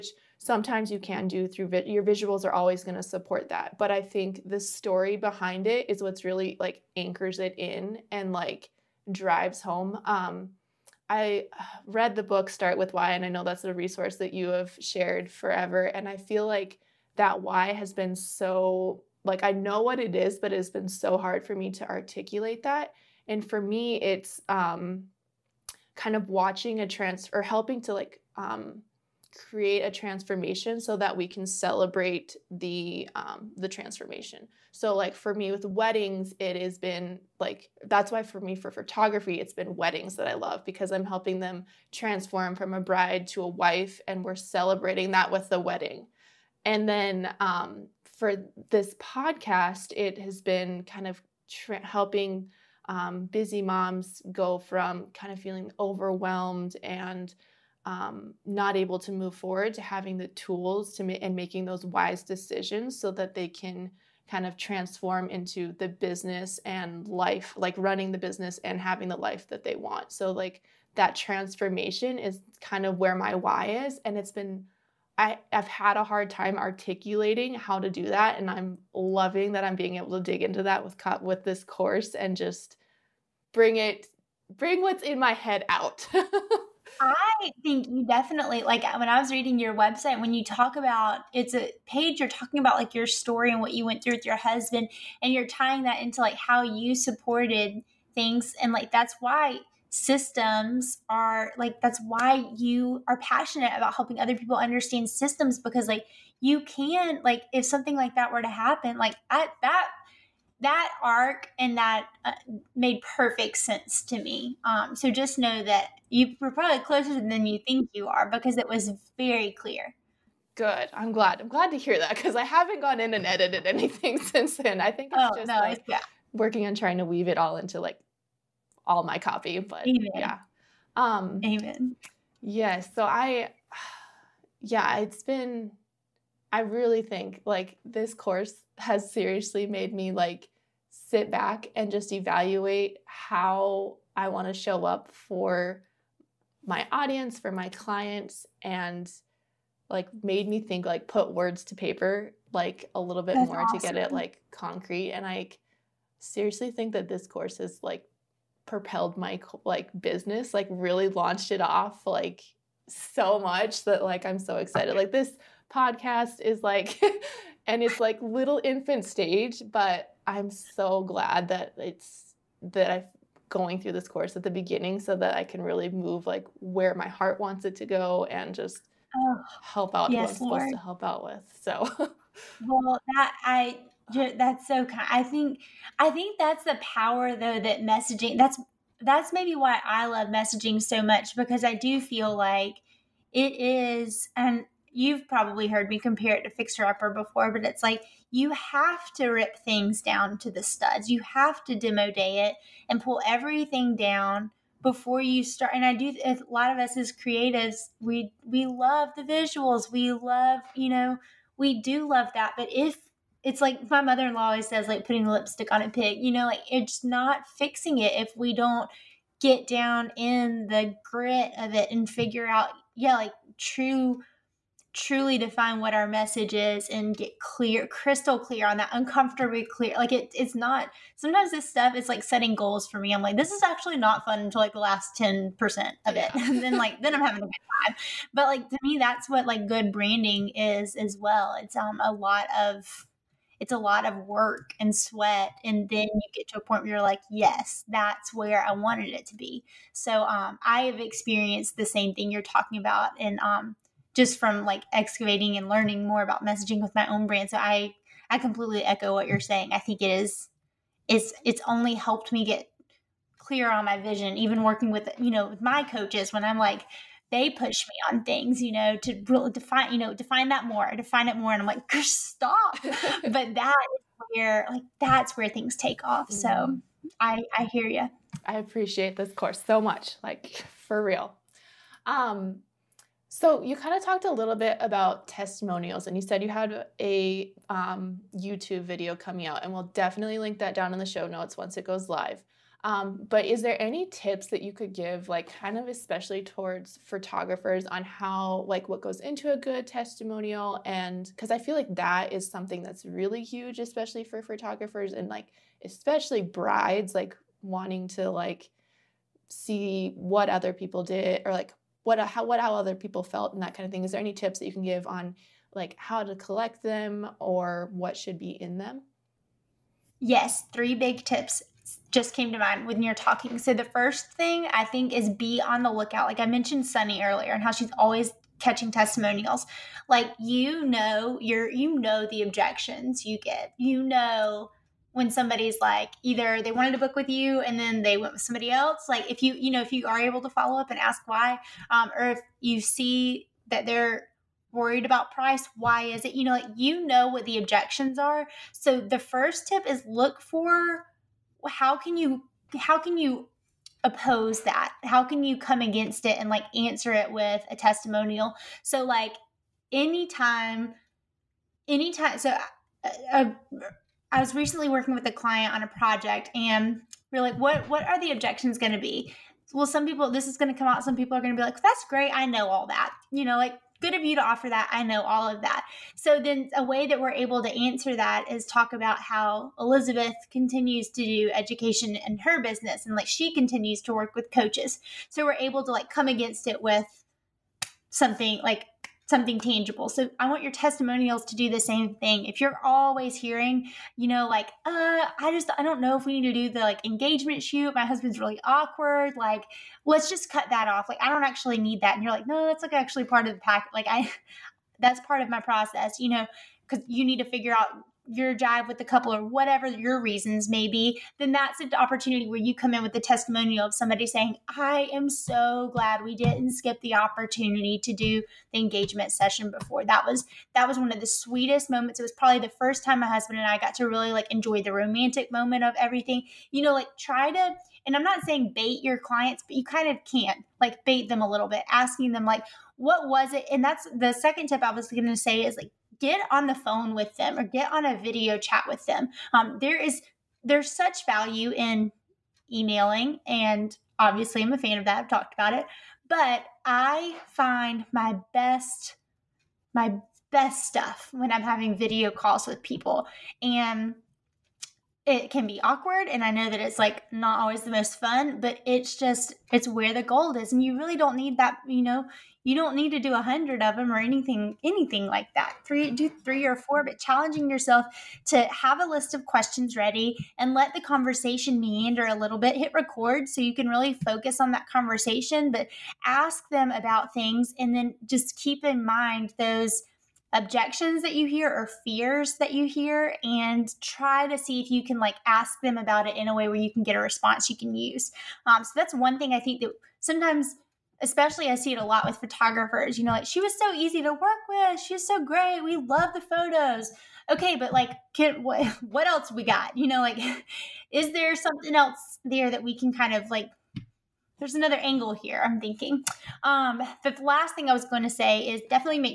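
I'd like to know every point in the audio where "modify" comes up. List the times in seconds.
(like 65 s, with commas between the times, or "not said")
not said.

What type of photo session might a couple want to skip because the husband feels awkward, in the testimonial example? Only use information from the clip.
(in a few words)
Engagement shoot.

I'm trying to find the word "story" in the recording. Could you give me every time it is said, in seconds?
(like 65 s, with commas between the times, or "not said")
4 s, 93 s.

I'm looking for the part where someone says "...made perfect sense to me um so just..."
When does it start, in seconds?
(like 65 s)
112 s.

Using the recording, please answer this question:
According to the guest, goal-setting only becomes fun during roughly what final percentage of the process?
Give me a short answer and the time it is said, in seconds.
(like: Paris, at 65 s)
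10%, at 234 s.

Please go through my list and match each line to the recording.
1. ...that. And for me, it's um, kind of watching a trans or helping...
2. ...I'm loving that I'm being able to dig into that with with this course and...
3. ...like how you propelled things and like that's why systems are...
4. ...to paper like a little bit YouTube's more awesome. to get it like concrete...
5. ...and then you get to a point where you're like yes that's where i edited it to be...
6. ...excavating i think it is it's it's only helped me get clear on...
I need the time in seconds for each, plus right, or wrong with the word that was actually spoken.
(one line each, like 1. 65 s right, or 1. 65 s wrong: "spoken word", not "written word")
1. 22 s right
2. 78 s right
3. 96 s wrong: "supported", not "propelled"
4. 151 s wrong: "That", not "YouTube"
5. 245 s wrong: "wanted", not "edited"
6. 259 s wrong: "saying", not "excavating".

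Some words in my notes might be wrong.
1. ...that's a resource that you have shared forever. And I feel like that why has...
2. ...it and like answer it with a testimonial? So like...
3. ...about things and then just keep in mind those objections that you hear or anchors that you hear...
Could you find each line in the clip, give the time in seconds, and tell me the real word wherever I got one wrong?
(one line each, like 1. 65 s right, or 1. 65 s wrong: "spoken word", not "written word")
1. 13 s right
2. 356 s right
3. 476 s wrong: "fears", not "anchors".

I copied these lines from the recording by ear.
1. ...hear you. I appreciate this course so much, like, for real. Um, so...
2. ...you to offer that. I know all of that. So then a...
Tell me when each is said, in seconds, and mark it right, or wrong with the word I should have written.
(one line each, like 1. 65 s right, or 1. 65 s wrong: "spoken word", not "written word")
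1. 277 s right
2. 374 s right.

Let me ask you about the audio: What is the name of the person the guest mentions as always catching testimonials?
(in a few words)
Sunny.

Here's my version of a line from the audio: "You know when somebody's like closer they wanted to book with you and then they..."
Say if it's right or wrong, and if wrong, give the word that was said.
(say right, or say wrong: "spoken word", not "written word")
wrong: "either", not "closer".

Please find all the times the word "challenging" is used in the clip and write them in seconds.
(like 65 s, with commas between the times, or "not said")
467 s.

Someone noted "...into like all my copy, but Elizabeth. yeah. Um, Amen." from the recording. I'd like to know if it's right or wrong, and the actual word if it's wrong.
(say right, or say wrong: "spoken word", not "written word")
wrong: "Amen", not "Elizabeth".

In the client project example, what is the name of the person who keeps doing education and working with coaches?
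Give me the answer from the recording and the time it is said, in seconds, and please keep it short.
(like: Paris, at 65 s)
Elizabeth, at 379 s.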